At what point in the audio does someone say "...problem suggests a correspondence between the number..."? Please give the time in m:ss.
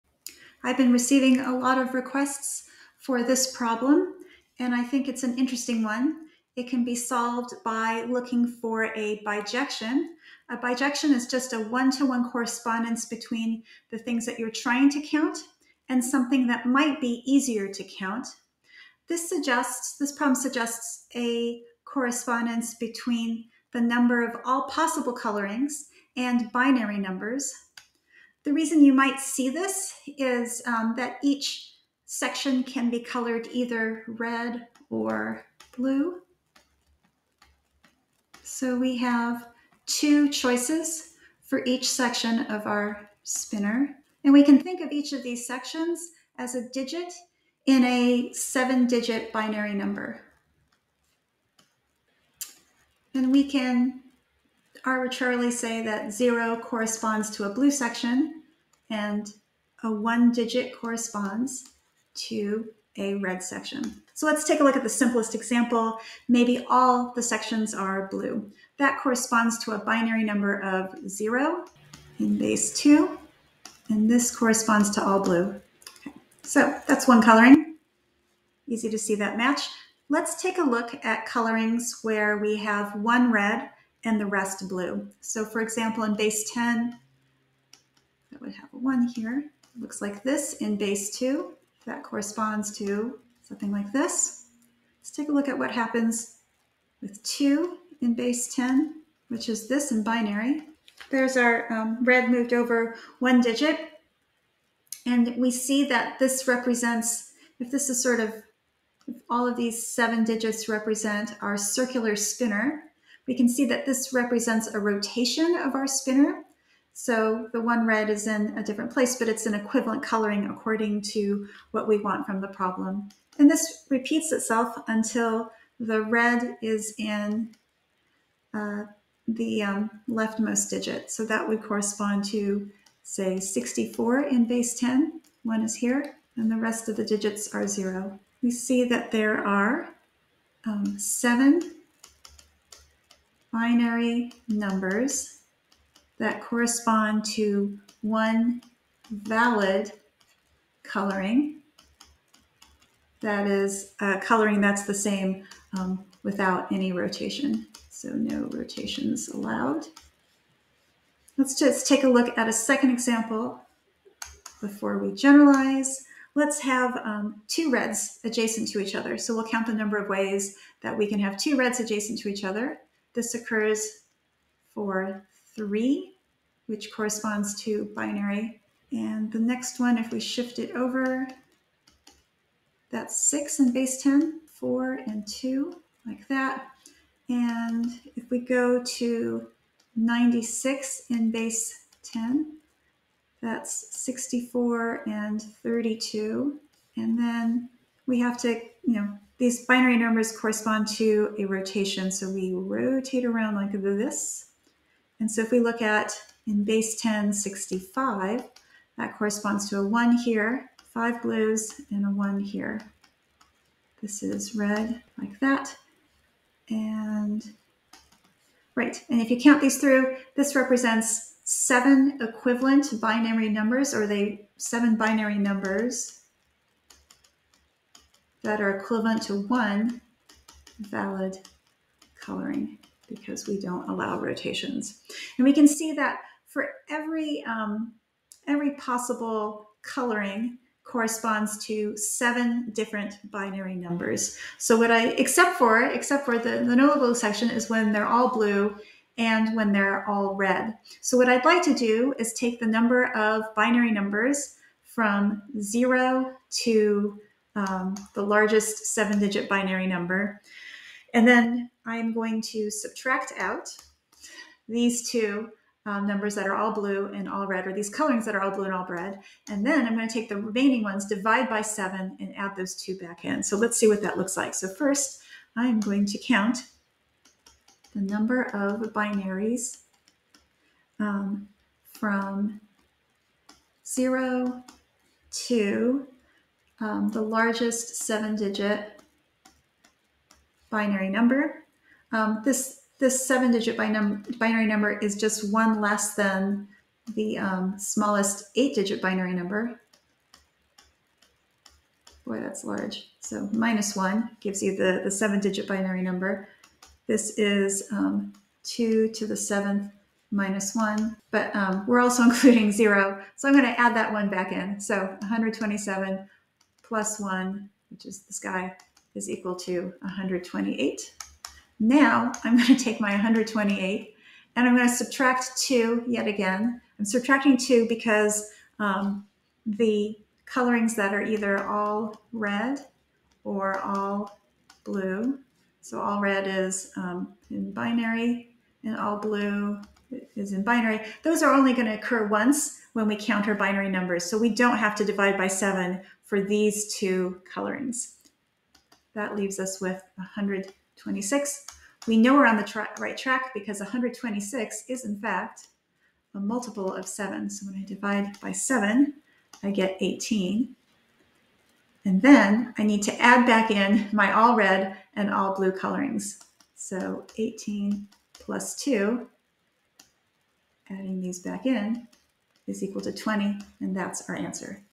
0:20.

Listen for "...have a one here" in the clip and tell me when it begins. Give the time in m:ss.
1:28.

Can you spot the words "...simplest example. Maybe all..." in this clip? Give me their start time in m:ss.
1:04.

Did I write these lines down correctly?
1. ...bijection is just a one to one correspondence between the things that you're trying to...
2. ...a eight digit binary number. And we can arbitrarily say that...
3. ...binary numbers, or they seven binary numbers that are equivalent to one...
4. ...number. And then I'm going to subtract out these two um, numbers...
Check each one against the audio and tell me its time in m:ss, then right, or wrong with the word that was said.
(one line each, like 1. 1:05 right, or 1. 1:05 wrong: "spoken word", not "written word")
1. 0:10 right
2. 0:47 wrong: "seven", not "eight"
3. 3:42 right
4. 4:19 right.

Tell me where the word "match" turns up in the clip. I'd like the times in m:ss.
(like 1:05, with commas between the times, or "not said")
1:19.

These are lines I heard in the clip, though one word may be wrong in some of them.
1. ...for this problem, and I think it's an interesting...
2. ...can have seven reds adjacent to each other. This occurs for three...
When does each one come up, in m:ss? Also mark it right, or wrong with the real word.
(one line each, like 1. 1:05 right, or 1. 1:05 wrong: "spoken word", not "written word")
1. 0:02 right
2. 2:51 wrong: "two", not "seven".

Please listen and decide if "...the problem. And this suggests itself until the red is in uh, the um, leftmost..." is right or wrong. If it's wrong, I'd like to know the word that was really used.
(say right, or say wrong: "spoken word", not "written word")
wrong: "repeats", not "suggests".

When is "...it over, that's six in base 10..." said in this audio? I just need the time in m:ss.
3:00.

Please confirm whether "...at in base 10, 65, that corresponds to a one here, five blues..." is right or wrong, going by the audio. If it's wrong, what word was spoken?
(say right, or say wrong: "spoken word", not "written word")
right.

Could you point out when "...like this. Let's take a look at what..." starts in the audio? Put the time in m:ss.
1:33.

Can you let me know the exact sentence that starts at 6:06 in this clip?
So 18 plus 2, adding these back in, is equal to 20, and that's our answer.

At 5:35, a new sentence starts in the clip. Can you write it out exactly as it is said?
So all red is um, in binary and all blue is in binary.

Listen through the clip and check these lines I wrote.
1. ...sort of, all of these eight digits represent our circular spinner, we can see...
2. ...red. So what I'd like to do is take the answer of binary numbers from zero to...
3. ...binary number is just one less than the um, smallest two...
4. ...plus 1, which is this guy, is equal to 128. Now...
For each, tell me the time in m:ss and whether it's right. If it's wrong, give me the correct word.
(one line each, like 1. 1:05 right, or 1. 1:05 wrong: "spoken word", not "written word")
1. 1:48 wrong: "seven", not "eight"
2. 4:10 wrong: "number", not "answer"
3. 4:53 wrong: "eight", not "two"
4. 5:16 right.